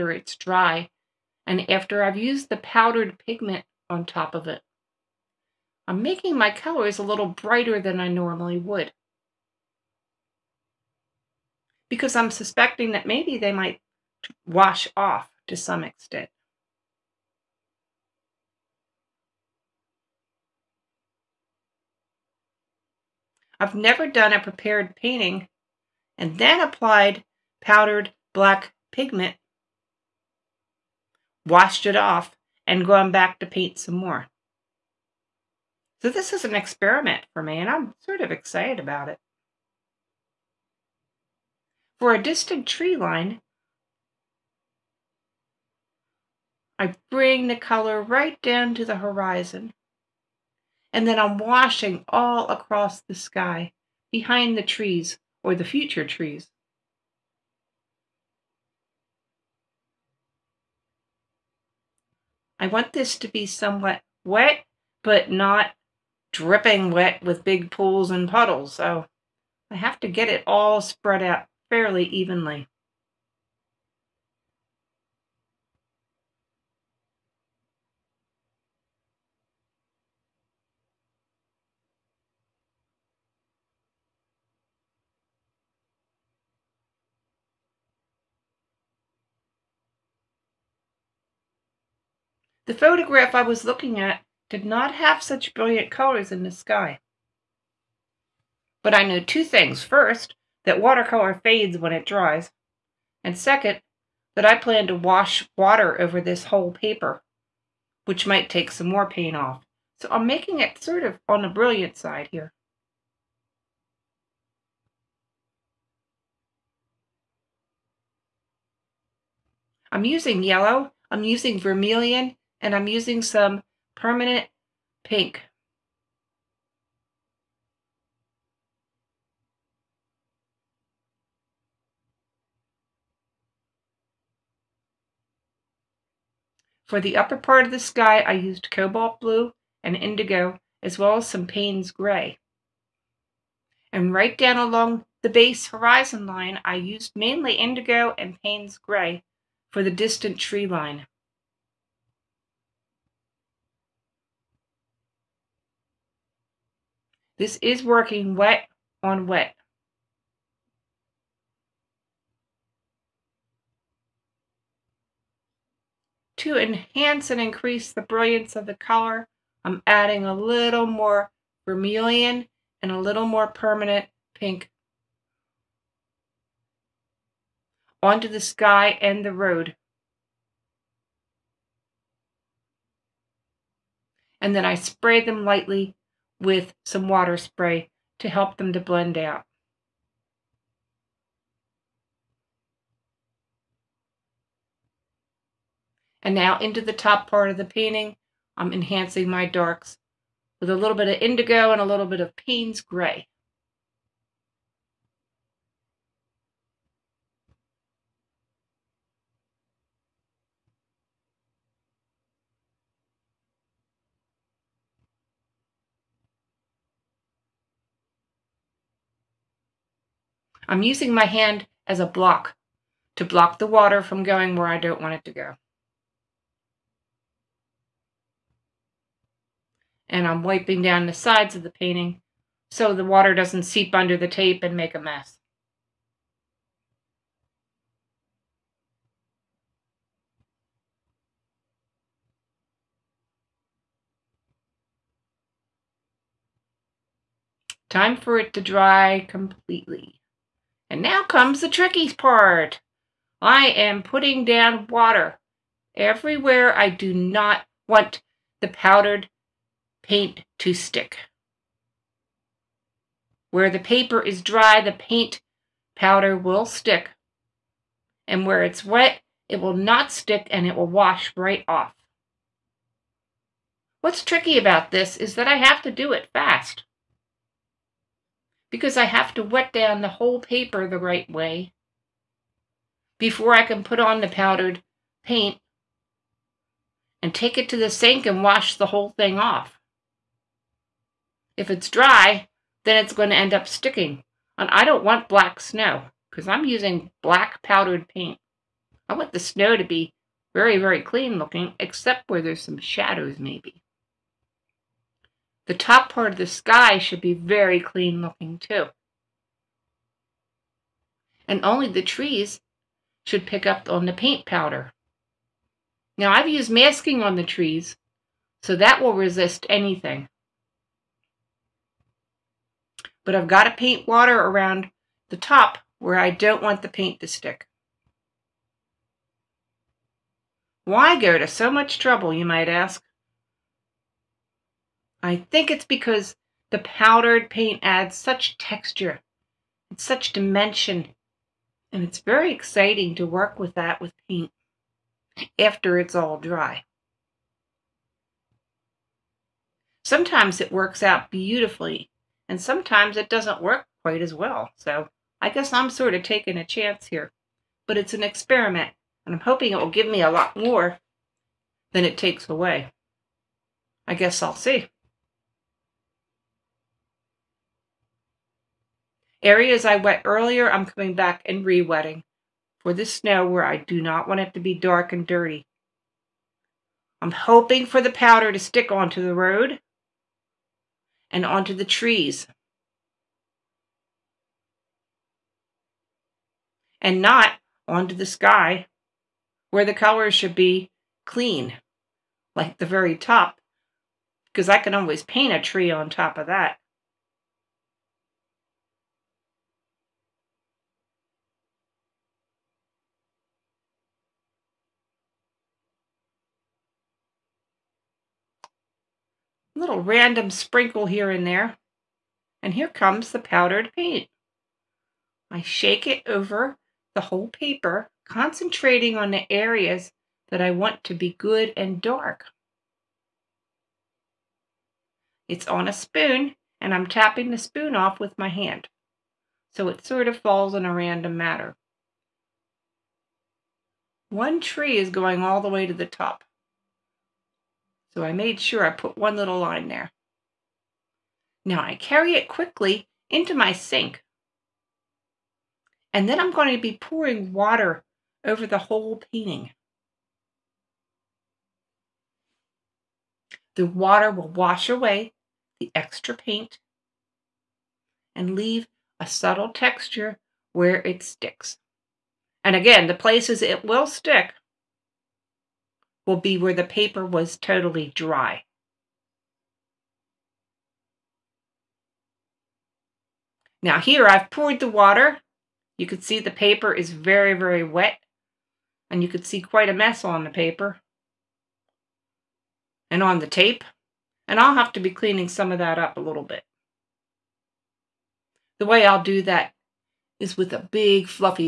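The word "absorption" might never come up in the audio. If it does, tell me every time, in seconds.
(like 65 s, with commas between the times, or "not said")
not said.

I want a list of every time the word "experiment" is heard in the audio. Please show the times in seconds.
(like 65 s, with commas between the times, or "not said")
36 s, 358 s.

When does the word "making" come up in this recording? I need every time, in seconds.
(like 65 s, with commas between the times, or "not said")
6 s, 110 s.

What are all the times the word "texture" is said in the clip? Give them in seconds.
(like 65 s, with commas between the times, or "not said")
338 s, 459 s.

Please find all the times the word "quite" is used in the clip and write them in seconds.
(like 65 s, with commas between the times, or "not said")
354 s, 479 s.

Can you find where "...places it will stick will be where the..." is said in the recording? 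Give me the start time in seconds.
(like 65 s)
463 s.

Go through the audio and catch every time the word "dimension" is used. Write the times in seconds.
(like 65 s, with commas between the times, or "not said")
340 s.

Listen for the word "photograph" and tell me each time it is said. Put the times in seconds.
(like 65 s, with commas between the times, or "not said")
92 s.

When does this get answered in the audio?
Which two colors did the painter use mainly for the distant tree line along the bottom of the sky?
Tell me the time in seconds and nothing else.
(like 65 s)
147 s.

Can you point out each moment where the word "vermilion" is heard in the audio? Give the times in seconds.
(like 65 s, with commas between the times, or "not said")
121 s, 171 s.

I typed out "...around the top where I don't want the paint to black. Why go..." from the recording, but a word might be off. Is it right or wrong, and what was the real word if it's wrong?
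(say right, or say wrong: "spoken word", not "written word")
wrong: "stick", not "black".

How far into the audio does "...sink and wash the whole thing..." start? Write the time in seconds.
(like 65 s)
287 s.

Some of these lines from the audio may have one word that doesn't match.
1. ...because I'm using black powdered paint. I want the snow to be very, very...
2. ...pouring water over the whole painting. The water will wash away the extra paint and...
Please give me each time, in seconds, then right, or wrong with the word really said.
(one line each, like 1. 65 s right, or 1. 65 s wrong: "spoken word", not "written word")
1. 296 s right
2. 446 s right.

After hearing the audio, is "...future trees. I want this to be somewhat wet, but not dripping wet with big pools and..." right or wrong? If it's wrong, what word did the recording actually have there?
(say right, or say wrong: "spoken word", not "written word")
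right.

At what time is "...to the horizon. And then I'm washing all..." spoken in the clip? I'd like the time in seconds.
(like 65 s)
48 s.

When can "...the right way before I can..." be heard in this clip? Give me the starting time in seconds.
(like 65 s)
280 s.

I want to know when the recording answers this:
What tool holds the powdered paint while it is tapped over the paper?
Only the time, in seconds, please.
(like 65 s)
425 s.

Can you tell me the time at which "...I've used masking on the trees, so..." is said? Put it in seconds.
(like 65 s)
316 s.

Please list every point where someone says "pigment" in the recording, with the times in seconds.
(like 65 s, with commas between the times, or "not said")
3 s, 28 s.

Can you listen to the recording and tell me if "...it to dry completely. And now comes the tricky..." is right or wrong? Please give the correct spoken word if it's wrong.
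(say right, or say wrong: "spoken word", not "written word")
right.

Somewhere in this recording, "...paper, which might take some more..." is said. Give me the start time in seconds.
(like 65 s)
106 s.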